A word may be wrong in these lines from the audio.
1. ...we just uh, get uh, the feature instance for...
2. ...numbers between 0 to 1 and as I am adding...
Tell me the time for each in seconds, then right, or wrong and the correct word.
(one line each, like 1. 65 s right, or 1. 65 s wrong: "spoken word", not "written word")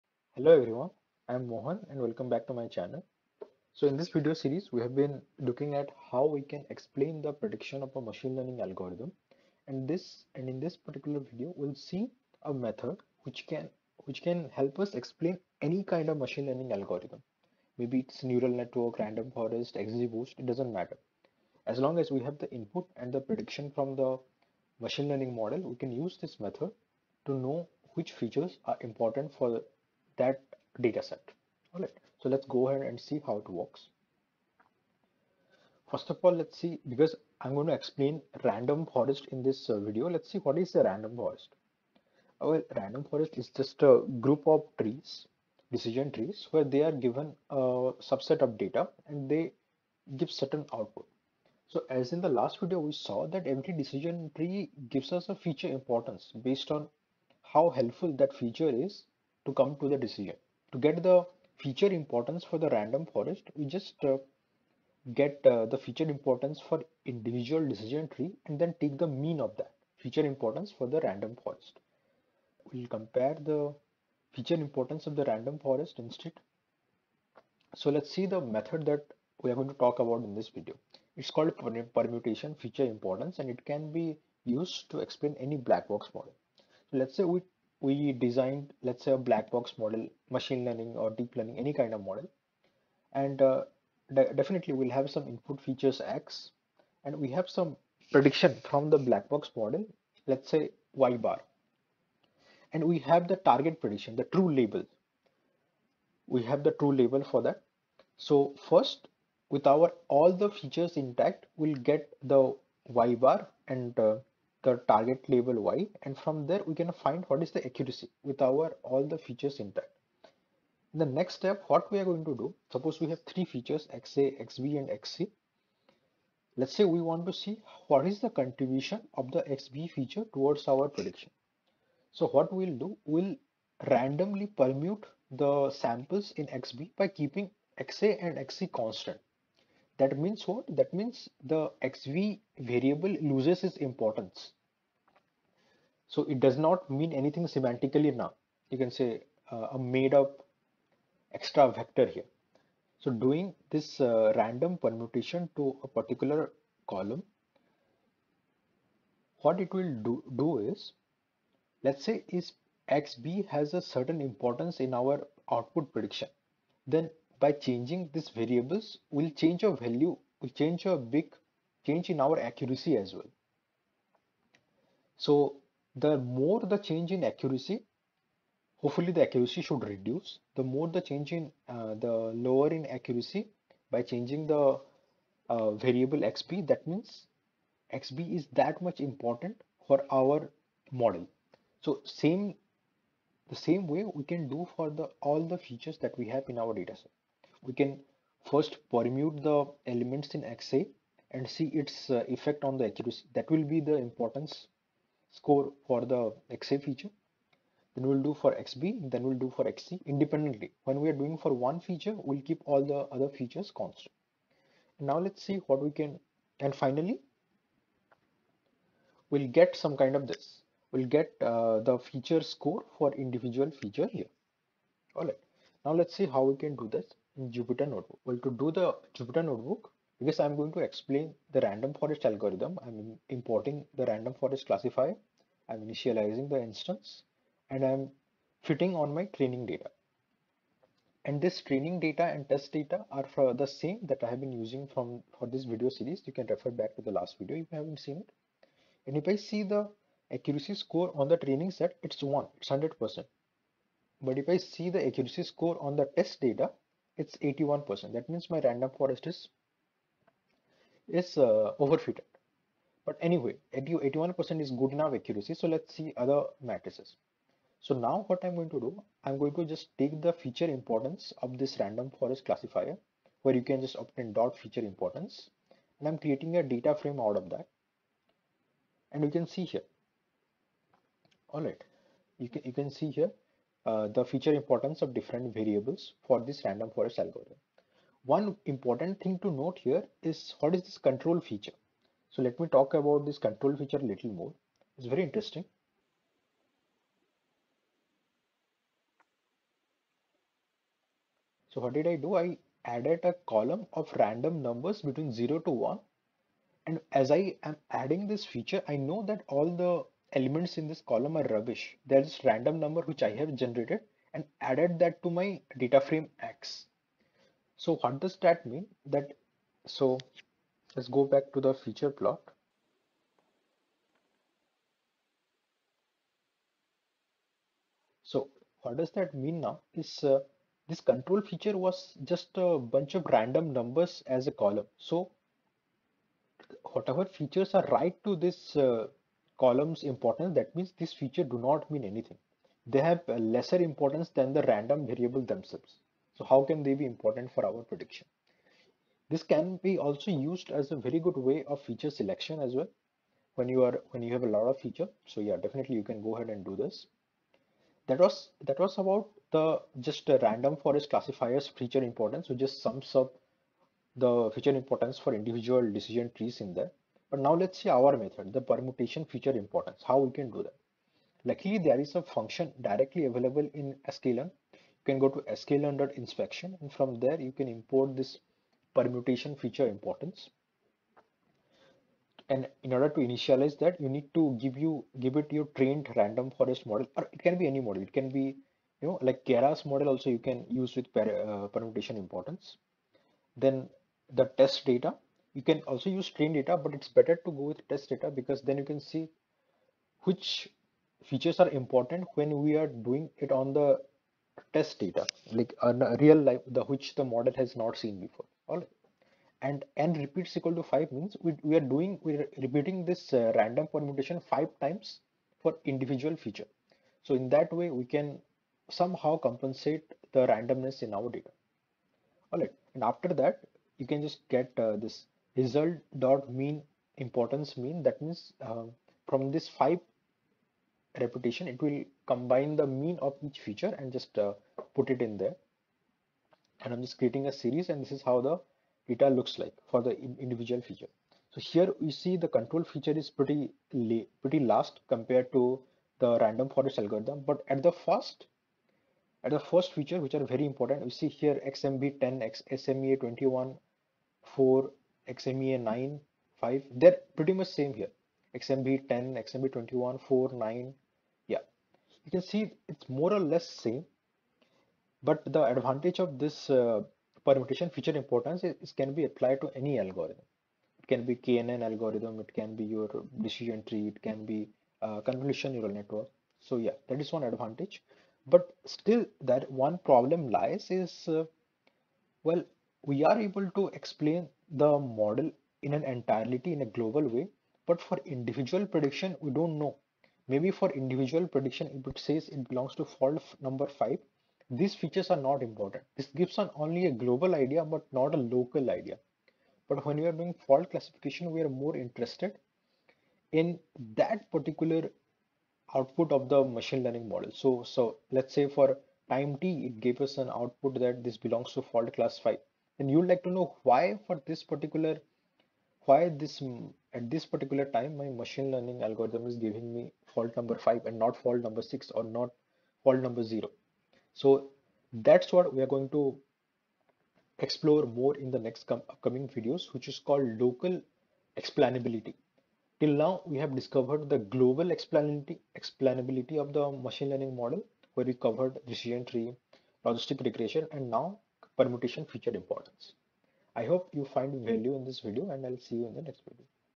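1. 63 s wrong: "importance", not "instance"
2. 304 s right.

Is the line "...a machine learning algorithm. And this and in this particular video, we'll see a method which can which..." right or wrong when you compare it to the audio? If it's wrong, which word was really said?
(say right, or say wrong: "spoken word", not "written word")
right.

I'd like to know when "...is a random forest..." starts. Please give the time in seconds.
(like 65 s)
40 s.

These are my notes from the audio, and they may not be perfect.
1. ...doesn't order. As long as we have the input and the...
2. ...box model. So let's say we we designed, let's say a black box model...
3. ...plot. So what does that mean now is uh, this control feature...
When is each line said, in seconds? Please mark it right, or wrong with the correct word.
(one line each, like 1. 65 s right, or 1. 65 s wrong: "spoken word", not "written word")
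1. 20 s wrong: "matter", not "order"
2. 85 s right
3. 322 s right.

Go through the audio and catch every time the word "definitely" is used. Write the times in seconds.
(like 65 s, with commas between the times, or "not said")
94 s, 355 s.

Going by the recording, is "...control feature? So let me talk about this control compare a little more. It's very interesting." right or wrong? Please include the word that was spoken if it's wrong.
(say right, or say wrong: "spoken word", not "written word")
wrong: "feature", not "compare".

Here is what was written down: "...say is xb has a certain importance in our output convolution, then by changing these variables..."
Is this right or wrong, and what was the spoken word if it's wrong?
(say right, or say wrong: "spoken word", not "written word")
wrong: "prediction", not "convolution".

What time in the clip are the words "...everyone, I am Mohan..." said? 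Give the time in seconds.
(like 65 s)
0 s.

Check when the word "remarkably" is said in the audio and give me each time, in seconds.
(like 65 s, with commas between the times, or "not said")
not said.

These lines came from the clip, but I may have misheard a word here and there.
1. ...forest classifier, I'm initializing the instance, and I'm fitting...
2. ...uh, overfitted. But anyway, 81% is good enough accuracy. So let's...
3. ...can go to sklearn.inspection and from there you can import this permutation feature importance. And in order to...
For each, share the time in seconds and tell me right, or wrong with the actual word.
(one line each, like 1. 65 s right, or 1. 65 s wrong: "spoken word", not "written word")
1. 234 s right
2. 261 s right
3. 375 s right.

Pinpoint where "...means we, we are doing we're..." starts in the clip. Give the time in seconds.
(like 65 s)
411 s.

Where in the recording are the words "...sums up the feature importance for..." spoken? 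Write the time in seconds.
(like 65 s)
362 s.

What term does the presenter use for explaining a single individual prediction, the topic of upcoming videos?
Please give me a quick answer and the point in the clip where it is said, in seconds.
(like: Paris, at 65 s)
Local explainability, at 530 s.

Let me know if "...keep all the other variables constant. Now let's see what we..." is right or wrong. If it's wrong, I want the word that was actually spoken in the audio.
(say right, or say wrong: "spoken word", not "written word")
wrong: "features", not "variables".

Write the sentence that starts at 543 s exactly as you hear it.
I hope you find value in this video and I'll see you in the next video.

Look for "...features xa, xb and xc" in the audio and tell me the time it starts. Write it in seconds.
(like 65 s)
123 s.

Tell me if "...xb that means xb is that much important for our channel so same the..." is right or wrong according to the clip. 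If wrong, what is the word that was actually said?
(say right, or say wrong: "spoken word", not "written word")
wrong: "model", not "channel".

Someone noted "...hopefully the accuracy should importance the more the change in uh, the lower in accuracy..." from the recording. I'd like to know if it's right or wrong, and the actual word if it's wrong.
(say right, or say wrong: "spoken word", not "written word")
wrong: "reduce", not "importance".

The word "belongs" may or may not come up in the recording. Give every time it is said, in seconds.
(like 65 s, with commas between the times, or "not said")
492 s, 511 s.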